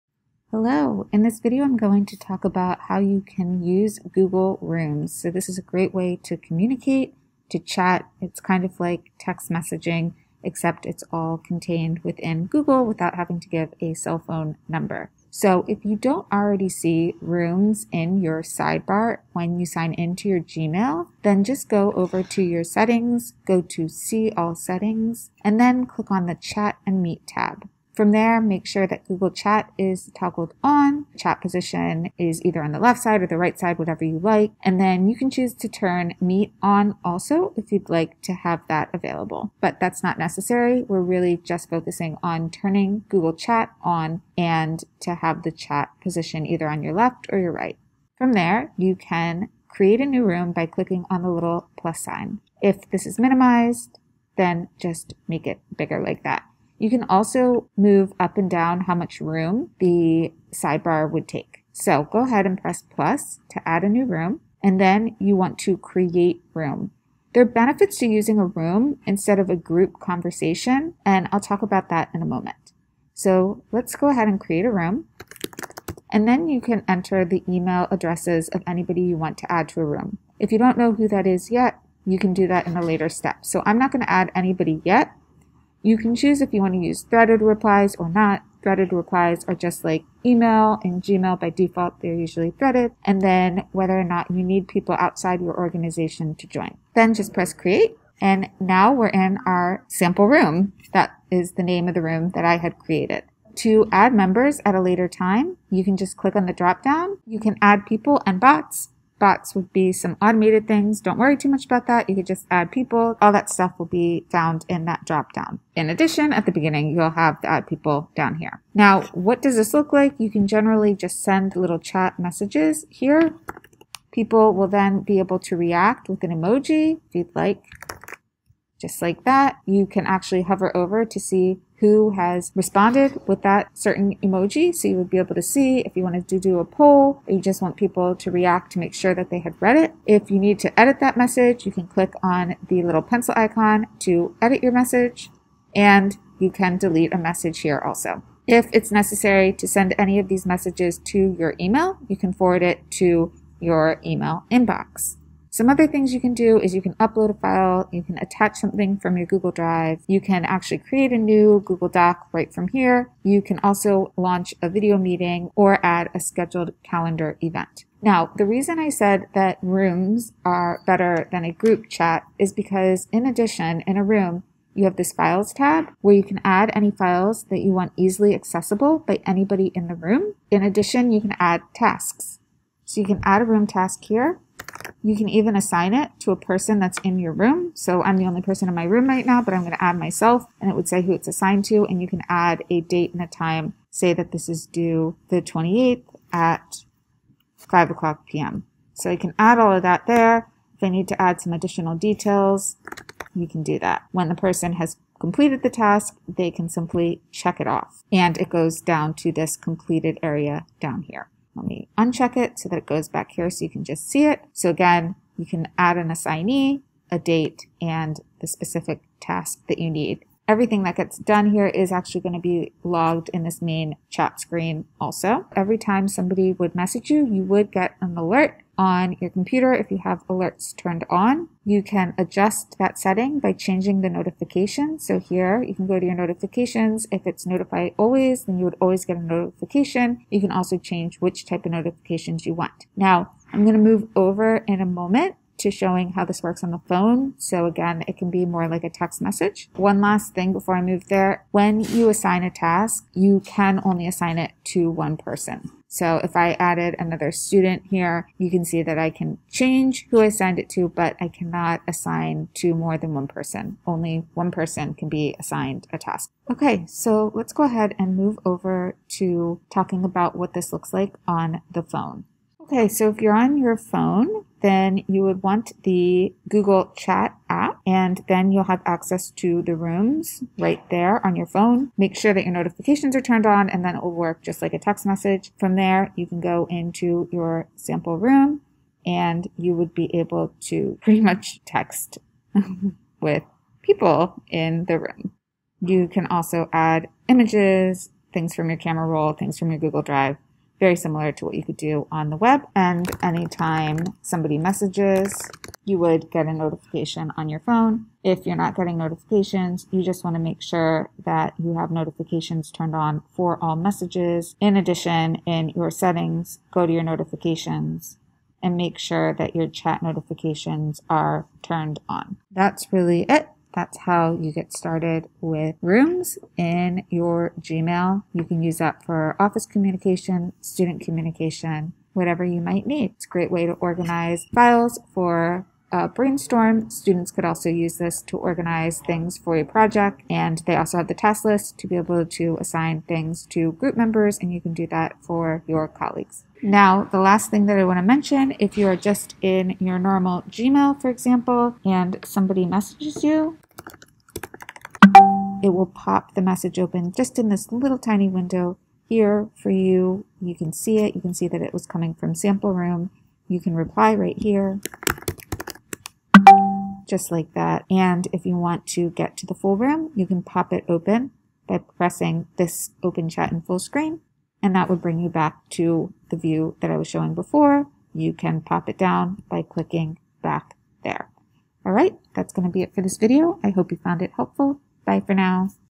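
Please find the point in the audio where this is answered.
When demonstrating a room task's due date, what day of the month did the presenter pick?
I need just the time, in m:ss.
3:15.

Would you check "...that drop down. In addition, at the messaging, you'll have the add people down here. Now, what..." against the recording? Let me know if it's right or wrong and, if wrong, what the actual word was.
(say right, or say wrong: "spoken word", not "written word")
wrong: "beginning", not "messaging".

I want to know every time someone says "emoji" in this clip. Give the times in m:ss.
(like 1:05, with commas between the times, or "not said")
2:06, 2:14.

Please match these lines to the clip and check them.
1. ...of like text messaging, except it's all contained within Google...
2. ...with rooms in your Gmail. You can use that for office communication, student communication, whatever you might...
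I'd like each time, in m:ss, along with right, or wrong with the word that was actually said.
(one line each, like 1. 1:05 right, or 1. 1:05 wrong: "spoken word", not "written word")
1. 0:08 right
2. 5:25 right.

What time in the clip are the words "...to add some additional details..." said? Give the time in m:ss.
3:21.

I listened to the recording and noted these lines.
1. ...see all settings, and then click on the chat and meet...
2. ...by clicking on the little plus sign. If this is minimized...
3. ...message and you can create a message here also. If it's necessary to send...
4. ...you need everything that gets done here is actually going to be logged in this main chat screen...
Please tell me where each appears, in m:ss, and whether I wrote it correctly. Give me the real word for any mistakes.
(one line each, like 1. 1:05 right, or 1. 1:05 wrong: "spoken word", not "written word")
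1. 0:23 right
2. 0:50 right
3. 2:24 wrong: "delete", not "create"
4. 3:39 right.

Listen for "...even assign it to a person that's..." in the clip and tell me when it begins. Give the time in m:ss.
3:05.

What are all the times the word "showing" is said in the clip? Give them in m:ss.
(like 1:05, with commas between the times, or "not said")
4:05, 6:17.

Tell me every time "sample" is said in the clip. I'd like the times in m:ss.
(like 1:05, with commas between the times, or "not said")
1:39, 4:47, 6:02.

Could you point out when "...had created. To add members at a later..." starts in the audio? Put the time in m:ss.
1:42.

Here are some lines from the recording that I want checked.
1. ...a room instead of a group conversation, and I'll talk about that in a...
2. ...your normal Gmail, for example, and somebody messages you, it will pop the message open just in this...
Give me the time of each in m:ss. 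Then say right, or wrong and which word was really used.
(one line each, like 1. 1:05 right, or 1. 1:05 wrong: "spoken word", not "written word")
1. 1:08 right
2. 5:49 right.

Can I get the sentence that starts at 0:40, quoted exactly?
We're really just focusing on turning Google Chat on and to have the chat position either on your left or your right.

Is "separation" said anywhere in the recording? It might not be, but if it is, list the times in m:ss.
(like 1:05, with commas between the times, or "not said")
not said.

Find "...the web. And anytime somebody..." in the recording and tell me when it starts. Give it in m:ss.
5:02.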